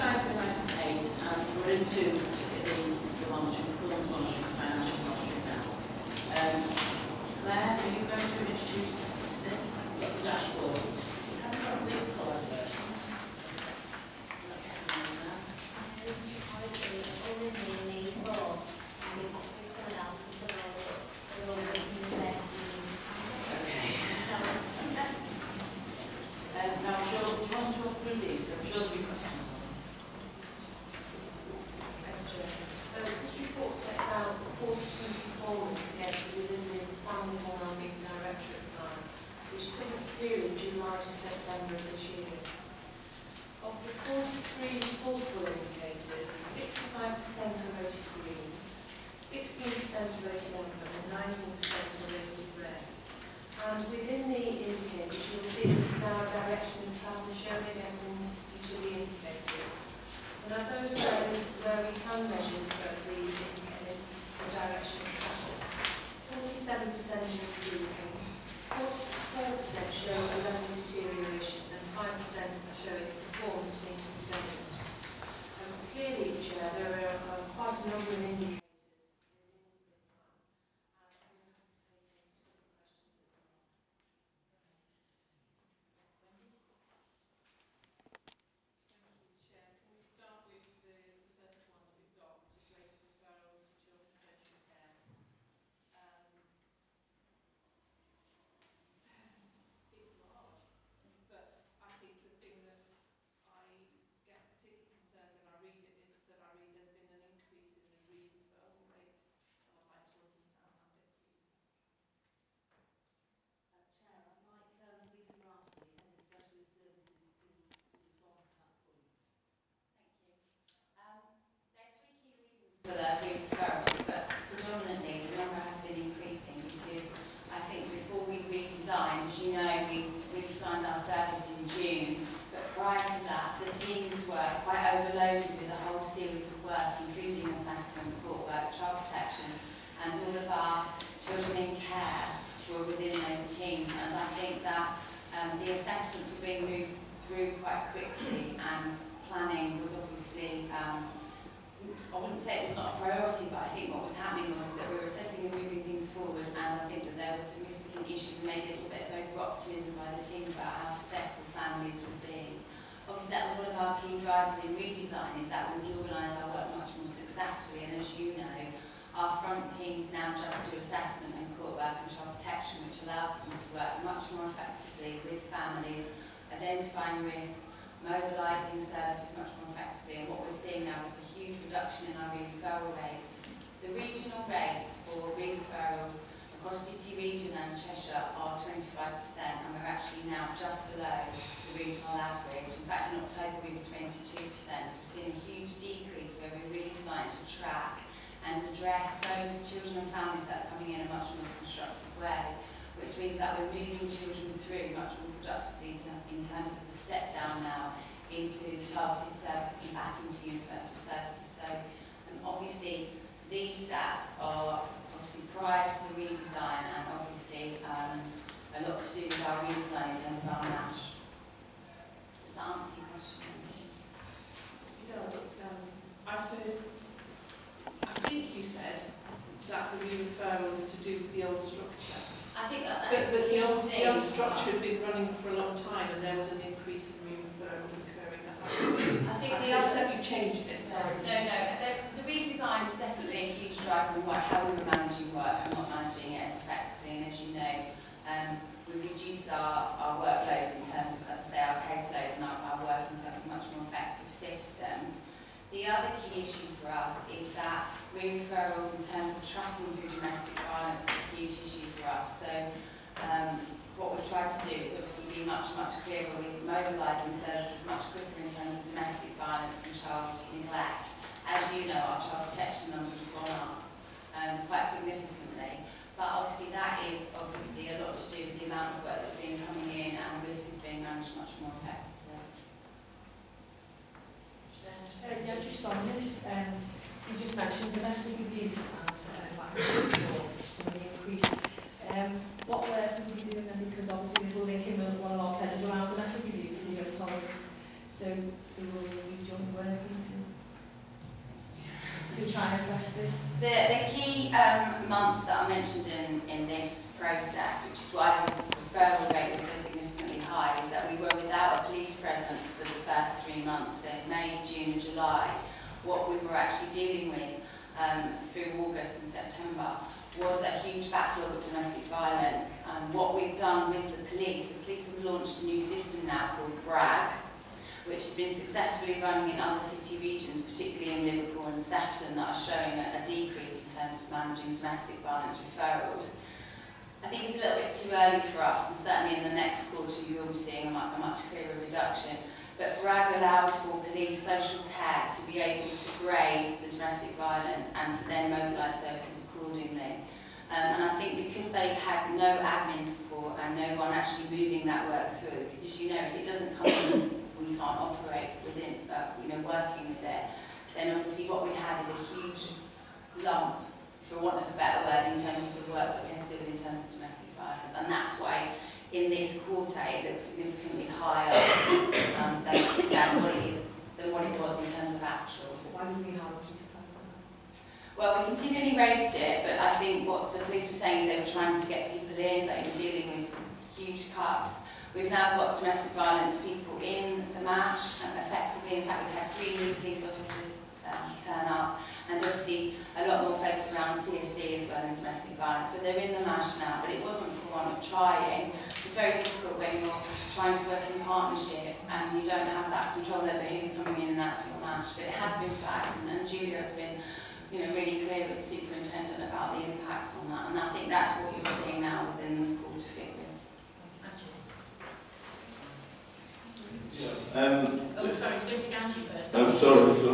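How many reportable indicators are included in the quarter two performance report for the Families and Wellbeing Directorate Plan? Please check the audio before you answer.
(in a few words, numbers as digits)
43.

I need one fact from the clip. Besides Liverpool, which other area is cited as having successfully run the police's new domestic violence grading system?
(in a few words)
Sefton.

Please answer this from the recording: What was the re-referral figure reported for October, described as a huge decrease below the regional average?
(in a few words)
22%.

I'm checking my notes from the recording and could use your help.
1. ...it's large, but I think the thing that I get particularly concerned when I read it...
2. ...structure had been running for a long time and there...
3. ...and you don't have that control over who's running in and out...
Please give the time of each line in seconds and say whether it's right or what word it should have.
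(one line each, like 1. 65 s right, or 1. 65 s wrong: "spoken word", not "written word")
1. 99 s right
2. 234 s right
3. 402 s wrong: "coming", not "running".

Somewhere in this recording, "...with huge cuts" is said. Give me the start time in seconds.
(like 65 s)
383 s.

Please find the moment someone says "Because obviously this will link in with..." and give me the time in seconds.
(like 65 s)
293 s.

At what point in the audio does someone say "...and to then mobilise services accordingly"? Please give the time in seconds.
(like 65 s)
347 s.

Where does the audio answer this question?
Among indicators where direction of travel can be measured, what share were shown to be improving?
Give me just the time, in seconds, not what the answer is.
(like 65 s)
66 s.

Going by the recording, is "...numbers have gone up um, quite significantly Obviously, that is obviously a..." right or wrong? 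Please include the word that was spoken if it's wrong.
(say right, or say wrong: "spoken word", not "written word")
right.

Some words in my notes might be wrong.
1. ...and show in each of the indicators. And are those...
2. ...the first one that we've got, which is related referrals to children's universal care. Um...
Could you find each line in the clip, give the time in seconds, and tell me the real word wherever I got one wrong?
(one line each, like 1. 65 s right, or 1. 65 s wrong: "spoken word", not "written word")
1. 57 s right
2. 91 s wrong: "social", not "universal".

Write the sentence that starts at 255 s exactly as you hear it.
The other key issue for us is that referrals in terms of tracking through domestic violence is a huge issue for us.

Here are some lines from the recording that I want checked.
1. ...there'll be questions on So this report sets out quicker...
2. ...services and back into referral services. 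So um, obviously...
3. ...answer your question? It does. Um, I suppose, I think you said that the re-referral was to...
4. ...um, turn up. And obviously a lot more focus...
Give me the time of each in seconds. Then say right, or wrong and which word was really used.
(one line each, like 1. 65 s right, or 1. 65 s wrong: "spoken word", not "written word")
1. 28 s wrong: "quarter", not "quicker"
2. 209 s wrong: "universal", not "referral"
3. 222 s right
4. 391 s right.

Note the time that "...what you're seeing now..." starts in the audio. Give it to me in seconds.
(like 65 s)
411 s.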